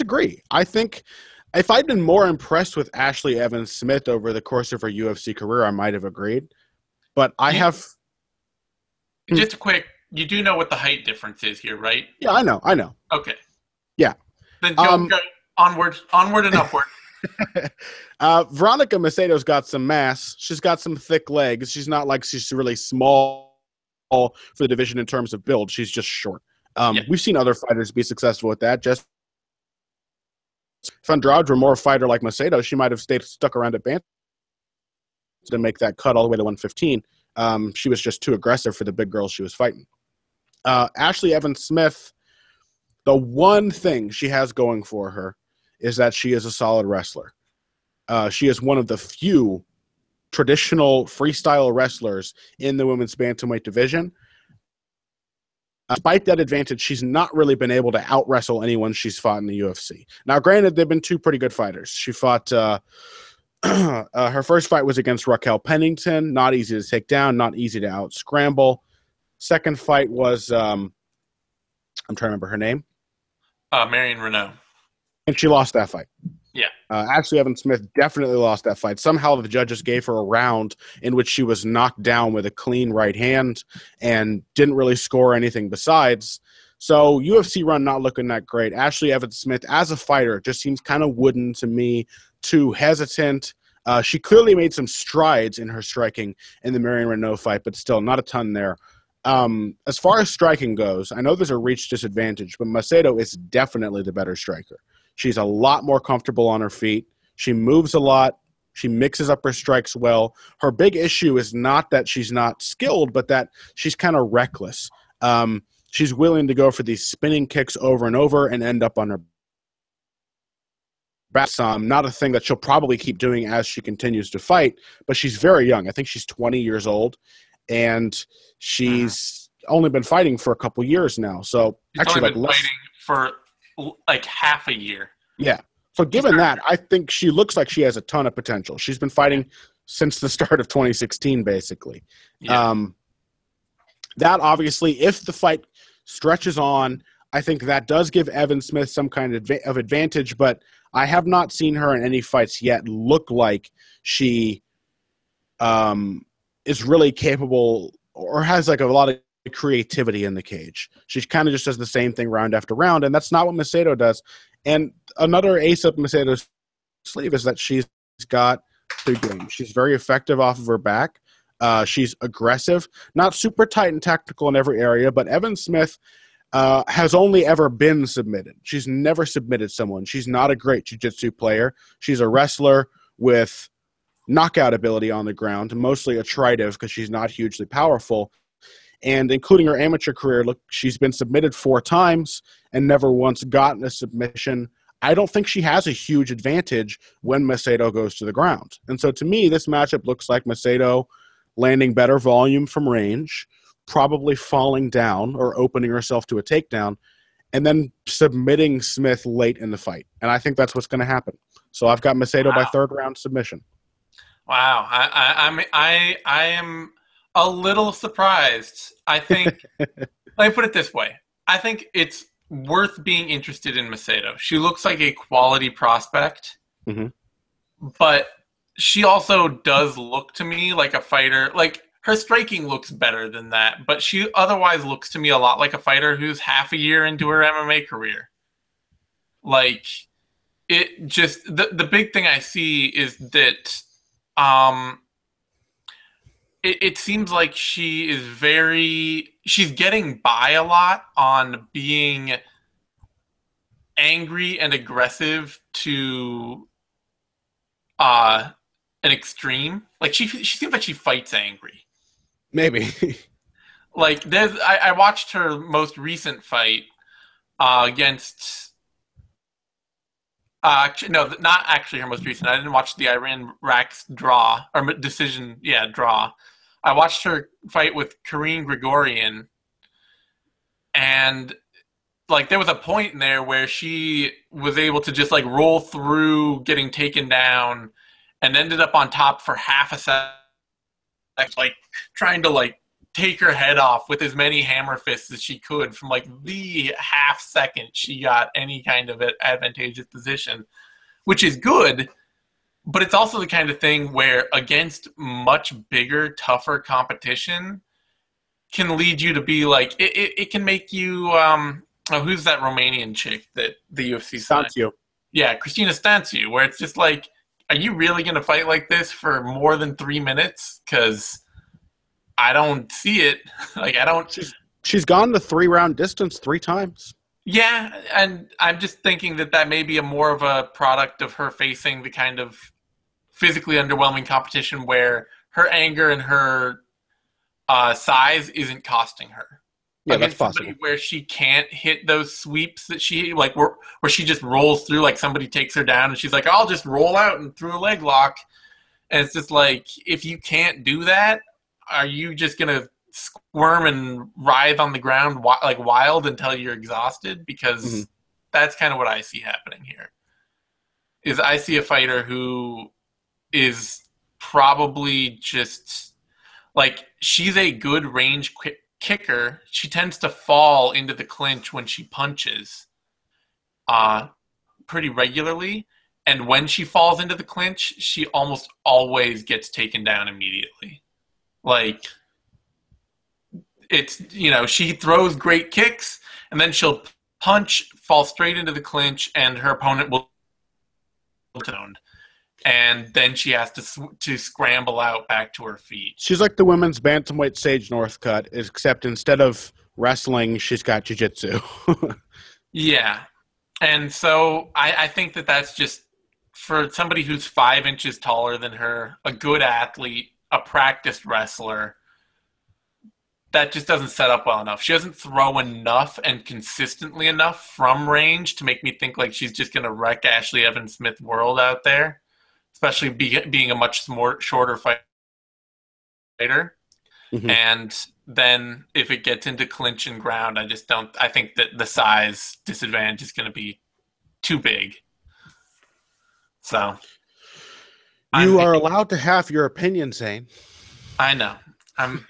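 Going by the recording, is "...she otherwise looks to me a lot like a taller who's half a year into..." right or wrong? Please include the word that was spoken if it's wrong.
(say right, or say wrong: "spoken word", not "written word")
wrong: "fighter", not "taller".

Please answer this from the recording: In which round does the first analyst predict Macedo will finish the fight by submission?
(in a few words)
Third.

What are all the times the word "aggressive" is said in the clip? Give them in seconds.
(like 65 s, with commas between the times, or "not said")
38 s, 172 s, 254 s.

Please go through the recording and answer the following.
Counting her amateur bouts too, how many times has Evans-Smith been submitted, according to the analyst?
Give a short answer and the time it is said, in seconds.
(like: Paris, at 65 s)
4, at 191 s.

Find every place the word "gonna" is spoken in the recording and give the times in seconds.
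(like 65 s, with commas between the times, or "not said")
318 s, 352 s.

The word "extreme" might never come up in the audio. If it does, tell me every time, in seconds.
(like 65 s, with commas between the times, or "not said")
259 s.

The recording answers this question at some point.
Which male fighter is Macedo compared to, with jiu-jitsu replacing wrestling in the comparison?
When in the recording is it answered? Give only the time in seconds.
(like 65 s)
397 s.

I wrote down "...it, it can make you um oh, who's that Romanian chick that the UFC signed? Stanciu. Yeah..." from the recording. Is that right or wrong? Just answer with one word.
right.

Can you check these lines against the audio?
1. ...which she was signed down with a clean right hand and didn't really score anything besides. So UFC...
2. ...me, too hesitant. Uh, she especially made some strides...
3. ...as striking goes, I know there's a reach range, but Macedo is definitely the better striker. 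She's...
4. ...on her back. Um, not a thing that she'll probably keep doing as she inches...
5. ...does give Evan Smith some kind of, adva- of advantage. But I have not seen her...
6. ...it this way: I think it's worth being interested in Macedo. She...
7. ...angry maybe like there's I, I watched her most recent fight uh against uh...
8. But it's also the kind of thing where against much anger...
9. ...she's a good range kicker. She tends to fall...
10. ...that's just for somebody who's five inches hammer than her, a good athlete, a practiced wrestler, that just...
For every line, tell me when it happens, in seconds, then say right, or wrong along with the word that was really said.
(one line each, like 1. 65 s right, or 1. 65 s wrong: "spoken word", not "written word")
1. 81 s wrong: "knocked", not "signed"
2. 91 s wrong: "clearly", not "especially"
3. 100 s wrong: "disadvantage", not "range"
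4. 118 s wrong: "continues", not "inches"
5. 147 s right
6. 220 s right
7. 261 s right
8. 302 s wrong: "bigger", not "anger"
9. 367 s right
10. 405 s wrong: "taller", not "hammer".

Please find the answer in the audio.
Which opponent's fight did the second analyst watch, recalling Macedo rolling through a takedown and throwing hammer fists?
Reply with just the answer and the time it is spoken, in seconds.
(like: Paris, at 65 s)
Kareen Gregorian, at 278 s.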